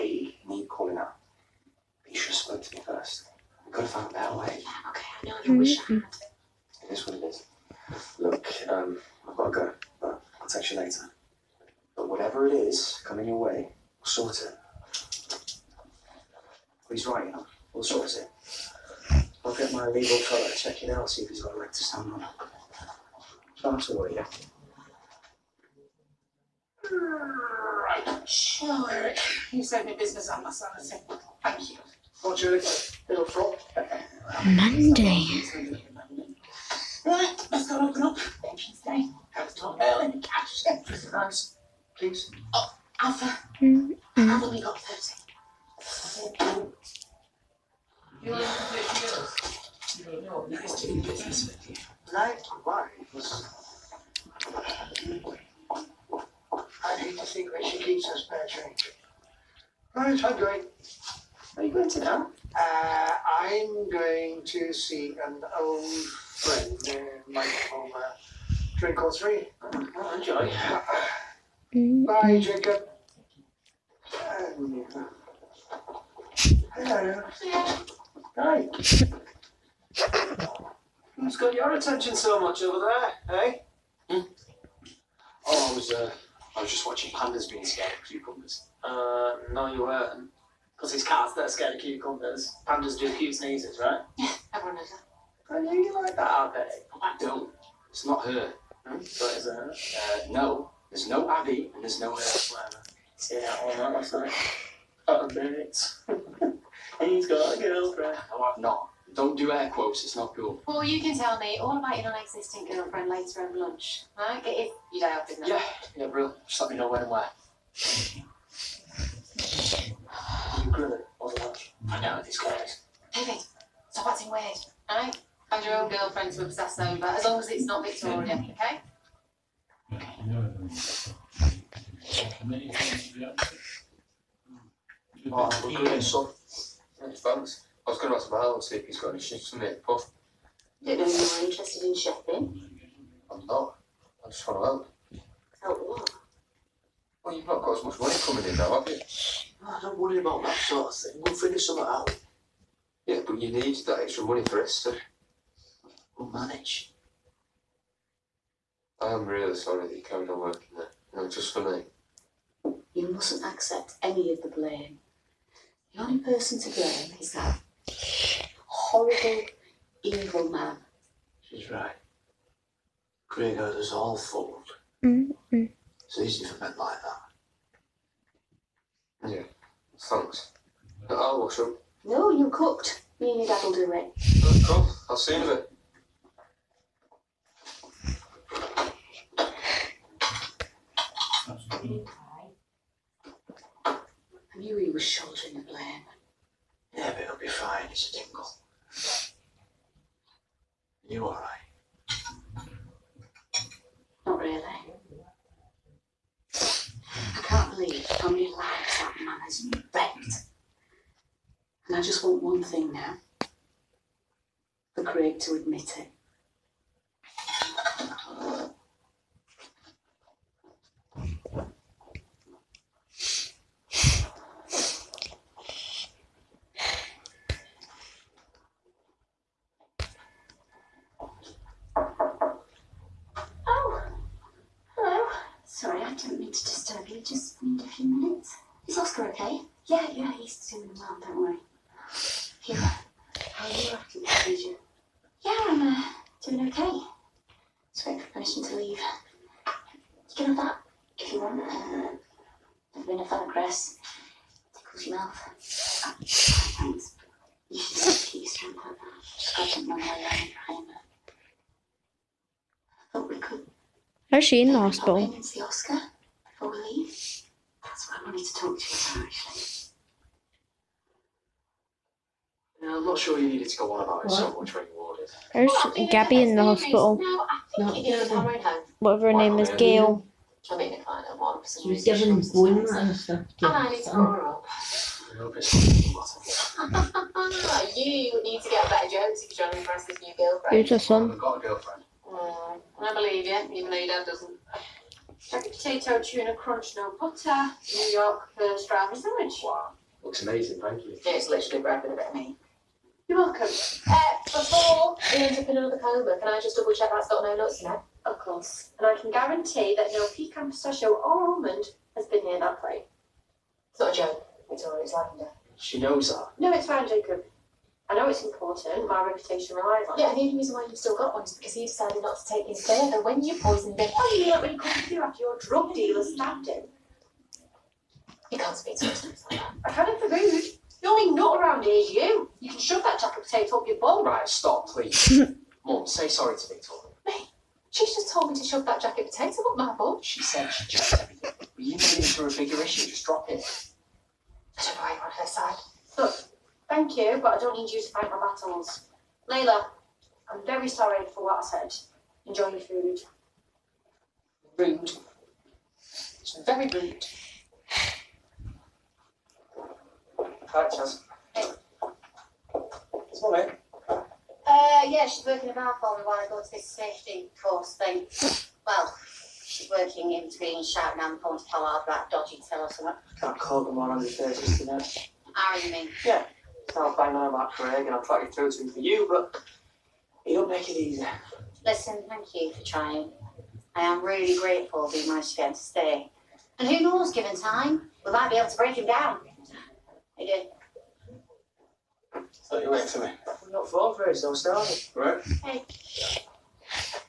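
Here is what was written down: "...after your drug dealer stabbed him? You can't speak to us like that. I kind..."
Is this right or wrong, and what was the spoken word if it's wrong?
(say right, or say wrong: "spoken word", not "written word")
right.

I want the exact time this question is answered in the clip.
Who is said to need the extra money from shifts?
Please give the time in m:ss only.
2:34.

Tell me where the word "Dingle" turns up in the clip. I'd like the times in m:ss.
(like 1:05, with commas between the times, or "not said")
3:18.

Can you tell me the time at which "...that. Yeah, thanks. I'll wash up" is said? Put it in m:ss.
2:57.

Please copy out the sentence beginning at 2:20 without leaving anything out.
Don't know if you're interested in shopping.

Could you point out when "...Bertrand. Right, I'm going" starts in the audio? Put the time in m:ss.
0:58.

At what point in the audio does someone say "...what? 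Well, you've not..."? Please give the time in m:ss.
2:25.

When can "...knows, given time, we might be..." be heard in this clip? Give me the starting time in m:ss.
6:27.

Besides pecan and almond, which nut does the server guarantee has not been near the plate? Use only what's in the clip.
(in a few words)
Pistachio.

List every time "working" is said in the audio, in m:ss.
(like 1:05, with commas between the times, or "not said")
2:40, 6:05, 6:09.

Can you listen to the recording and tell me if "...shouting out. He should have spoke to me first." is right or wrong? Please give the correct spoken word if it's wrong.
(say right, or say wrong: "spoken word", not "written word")
wrong: "calling", not "shouting".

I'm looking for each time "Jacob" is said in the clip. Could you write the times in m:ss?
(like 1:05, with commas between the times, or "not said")
1:12, 5:17.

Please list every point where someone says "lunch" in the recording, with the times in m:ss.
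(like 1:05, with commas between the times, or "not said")
1:53, 2:01.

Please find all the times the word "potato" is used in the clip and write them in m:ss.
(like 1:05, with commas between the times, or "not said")
4:55, 5:33, 5:39.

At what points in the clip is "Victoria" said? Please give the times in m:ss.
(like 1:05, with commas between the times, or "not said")
2:07, 5:36.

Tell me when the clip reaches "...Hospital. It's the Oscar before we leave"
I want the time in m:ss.
4:24.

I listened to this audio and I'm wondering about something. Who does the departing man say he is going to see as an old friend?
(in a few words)
Michael.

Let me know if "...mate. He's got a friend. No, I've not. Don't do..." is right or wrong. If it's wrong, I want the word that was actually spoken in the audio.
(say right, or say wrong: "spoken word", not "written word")
wrong: "girlfriend", not "friend".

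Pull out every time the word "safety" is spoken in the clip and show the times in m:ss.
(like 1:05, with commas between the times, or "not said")
6:06.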